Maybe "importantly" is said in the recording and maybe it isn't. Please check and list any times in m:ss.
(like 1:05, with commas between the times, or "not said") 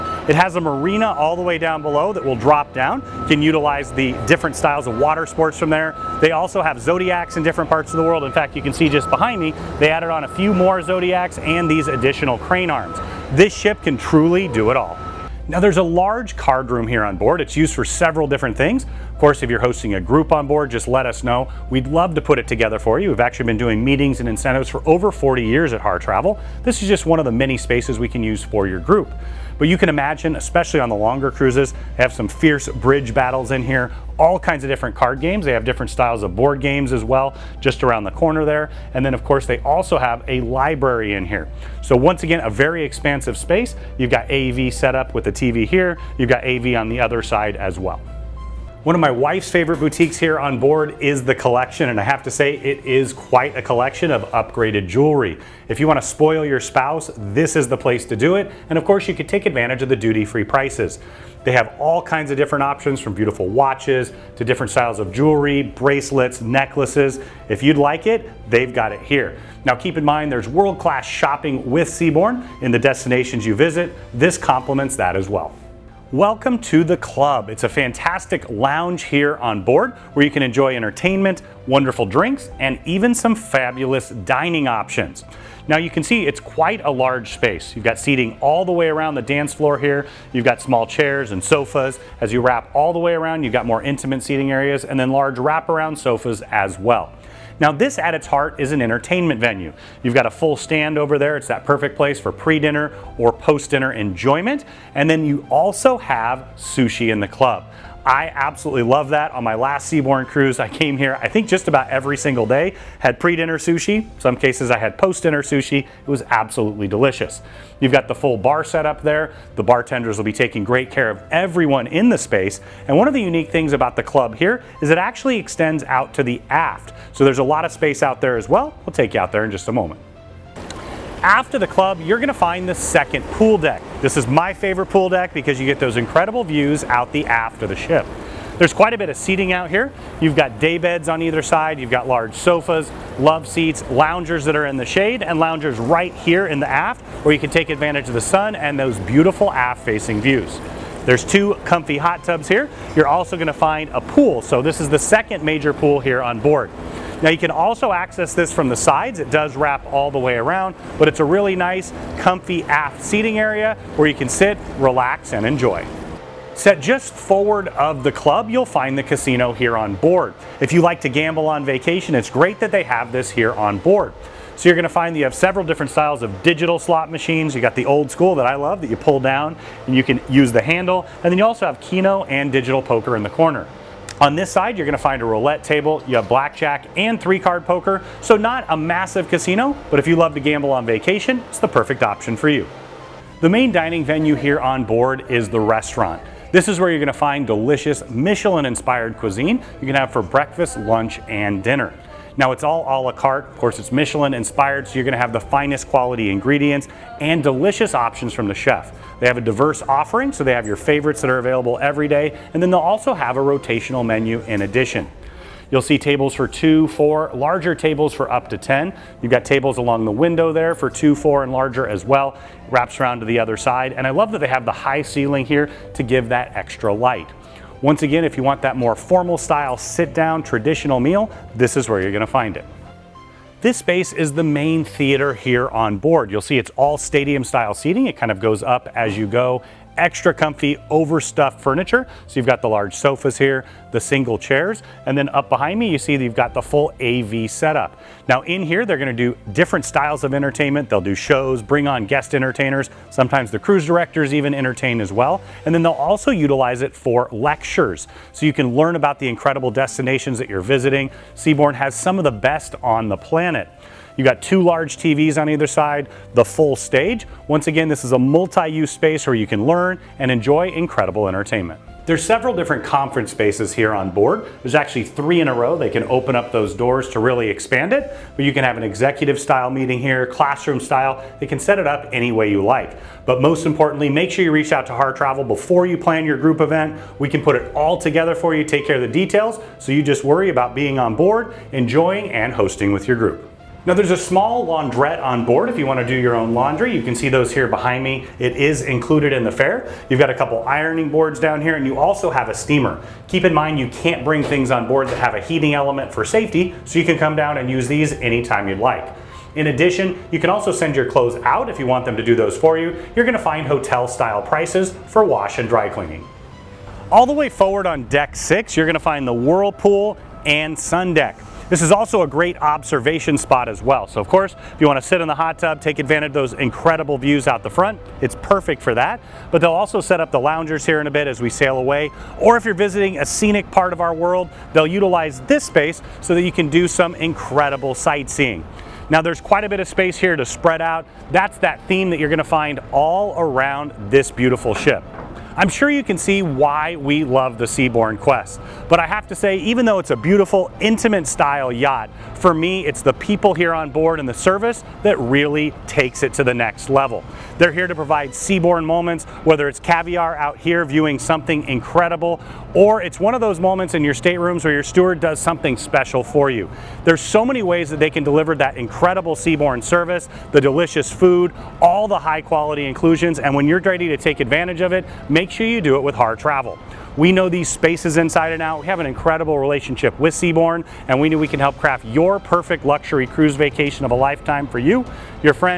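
4:43.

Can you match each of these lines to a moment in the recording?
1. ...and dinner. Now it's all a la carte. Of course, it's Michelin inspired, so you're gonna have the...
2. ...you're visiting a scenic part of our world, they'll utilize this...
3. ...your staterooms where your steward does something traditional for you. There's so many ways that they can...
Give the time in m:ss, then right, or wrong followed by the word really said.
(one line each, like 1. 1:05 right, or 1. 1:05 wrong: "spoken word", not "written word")
1. 3:21 right
2. 5:32 right
3. 6:04 wrong: "special", not "traditional".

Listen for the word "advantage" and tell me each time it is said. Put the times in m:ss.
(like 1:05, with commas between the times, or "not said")
0:59, 2:27, 5:25, 6:14.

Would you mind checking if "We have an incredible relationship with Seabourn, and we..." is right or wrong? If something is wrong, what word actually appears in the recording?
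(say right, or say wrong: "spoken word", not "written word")
right.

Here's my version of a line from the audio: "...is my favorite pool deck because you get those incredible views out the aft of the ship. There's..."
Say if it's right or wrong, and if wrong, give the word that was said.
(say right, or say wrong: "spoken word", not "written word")
right.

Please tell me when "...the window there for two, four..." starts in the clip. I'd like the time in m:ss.
3:40.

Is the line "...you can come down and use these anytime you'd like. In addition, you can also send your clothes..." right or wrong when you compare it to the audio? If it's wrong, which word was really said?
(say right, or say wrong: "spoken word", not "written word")
right.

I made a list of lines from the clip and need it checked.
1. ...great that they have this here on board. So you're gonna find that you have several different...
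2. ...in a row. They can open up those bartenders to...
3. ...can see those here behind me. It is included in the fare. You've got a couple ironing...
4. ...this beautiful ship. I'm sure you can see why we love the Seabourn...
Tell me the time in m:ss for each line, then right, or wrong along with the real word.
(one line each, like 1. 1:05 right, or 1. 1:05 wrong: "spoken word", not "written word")
1. 2:52 right
2. 4:35 wrong: "doors", not "bartenders"
3. 4:57 right
4. 5:44 right.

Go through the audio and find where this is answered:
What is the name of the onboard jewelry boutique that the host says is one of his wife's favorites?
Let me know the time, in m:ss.
0:51.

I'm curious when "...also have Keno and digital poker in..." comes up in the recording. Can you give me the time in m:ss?
3:01.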